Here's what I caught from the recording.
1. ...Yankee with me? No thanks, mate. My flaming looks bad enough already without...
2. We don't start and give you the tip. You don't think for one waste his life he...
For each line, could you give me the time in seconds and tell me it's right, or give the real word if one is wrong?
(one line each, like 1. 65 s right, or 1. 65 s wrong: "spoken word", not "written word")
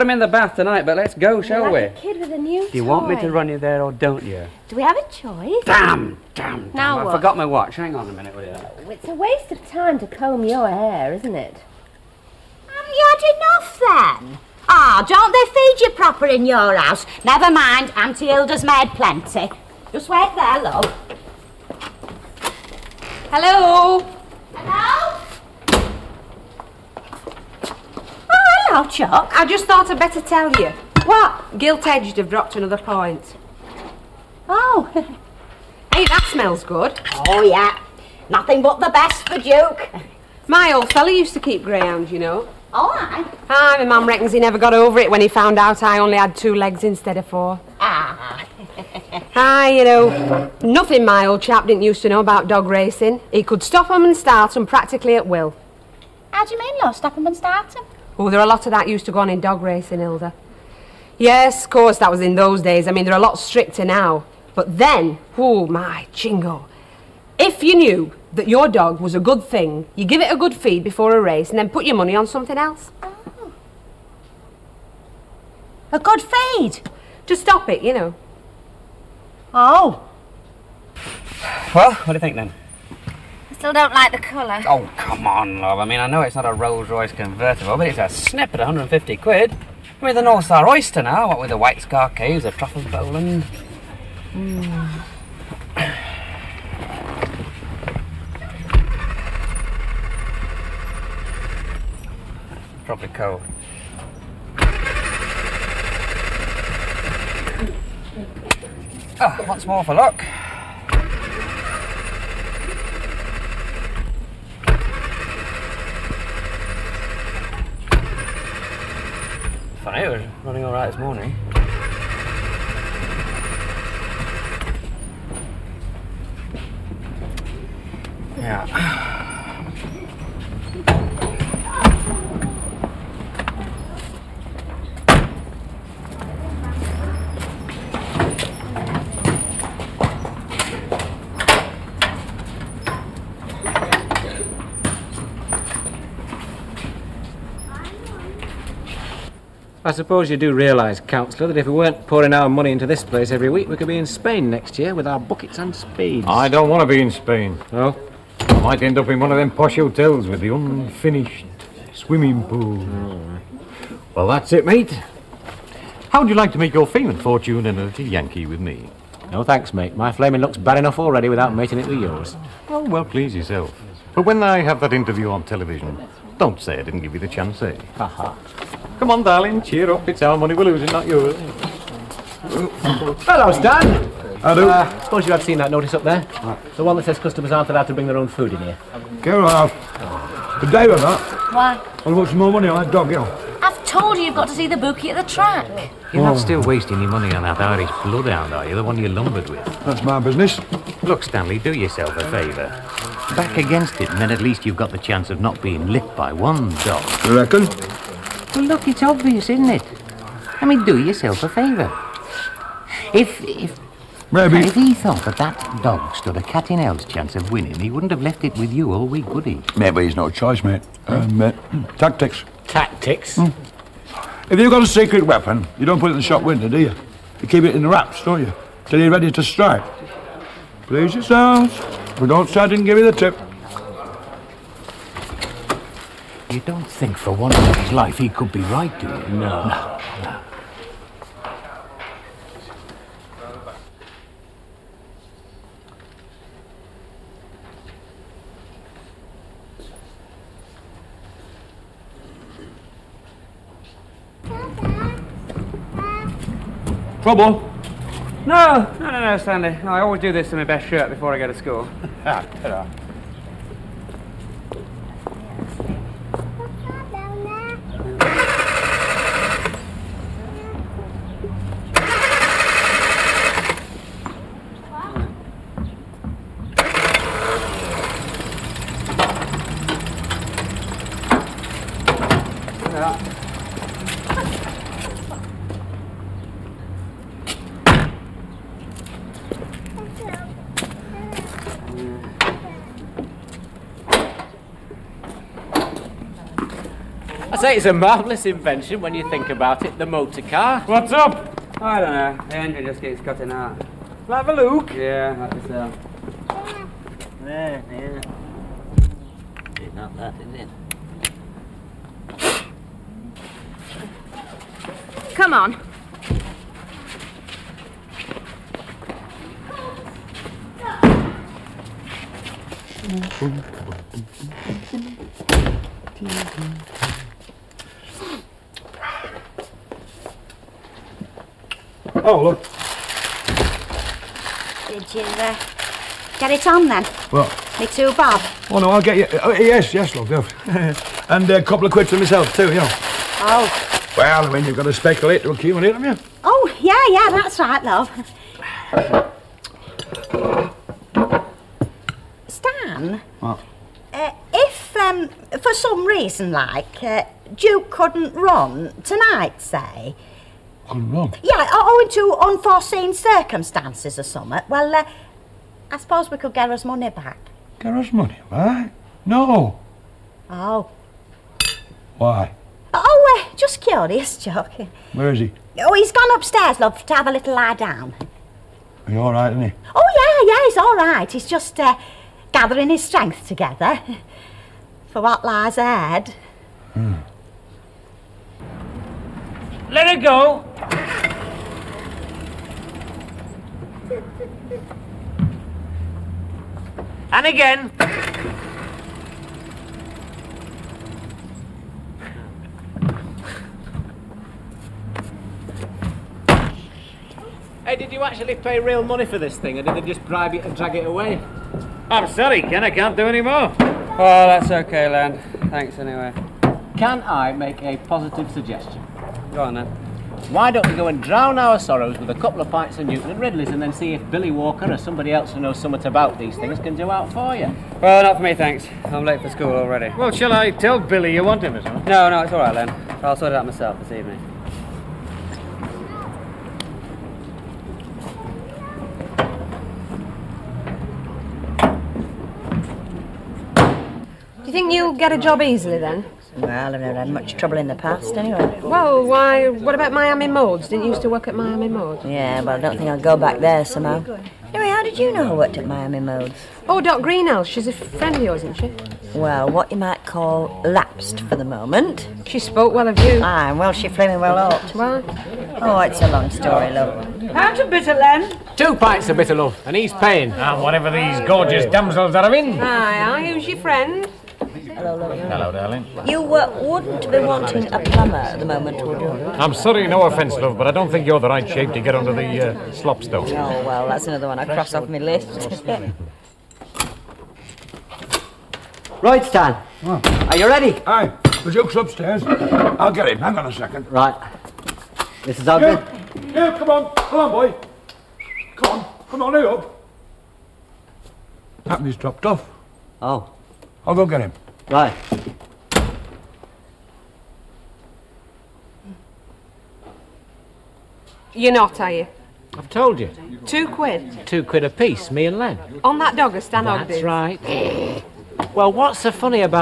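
1. 168 s right
2. 232 s wrong: "minute", not "waste".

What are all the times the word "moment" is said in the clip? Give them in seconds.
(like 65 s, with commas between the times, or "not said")
461 s, 478 s.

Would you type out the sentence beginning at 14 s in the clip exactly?
Ah, don't they feed you proper in your house?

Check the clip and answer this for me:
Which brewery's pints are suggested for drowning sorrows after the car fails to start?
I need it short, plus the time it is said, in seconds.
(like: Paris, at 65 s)
Newton and Ridley's, at 423 s.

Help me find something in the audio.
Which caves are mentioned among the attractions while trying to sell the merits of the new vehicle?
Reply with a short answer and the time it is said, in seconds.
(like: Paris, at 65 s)
White Scar Caves, at 91 s.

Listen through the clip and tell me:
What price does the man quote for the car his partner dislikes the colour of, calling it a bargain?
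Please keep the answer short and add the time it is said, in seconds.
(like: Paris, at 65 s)
150 quid, at 88 s.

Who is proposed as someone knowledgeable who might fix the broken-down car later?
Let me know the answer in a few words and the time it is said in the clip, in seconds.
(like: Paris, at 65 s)
Billy Walker, at 424 s.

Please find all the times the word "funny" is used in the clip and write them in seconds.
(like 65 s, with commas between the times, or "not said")
119 s, 519 s.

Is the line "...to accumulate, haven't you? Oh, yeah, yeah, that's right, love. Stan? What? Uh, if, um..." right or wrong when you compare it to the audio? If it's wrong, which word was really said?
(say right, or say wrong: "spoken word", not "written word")
right.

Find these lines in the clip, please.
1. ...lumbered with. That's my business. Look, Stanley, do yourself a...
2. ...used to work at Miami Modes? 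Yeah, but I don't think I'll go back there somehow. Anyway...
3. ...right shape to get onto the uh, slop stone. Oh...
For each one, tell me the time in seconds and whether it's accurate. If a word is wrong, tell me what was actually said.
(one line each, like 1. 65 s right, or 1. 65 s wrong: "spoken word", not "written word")
1. 199 s right
2. 451 s right
3. 481 s right.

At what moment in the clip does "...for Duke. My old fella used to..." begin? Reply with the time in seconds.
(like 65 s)
39 s.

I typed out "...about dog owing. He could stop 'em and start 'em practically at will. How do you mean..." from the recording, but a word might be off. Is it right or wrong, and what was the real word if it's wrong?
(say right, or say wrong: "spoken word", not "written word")
wrong: "racing", not "owing".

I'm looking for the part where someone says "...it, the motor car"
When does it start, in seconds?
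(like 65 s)
299 s.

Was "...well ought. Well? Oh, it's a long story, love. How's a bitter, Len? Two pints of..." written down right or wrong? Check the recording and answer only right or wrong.
right.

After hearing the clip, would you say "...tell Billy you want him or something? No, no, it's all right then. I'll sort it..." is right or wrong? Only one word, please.
right.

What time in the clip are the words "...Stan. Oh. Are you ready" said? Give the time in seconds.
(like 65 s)
489 s.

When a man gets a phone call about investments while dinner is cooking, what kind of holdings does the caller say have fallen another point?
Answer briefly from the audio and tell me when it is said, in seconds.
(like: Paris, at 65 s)
Gilt-edged, at 31 s.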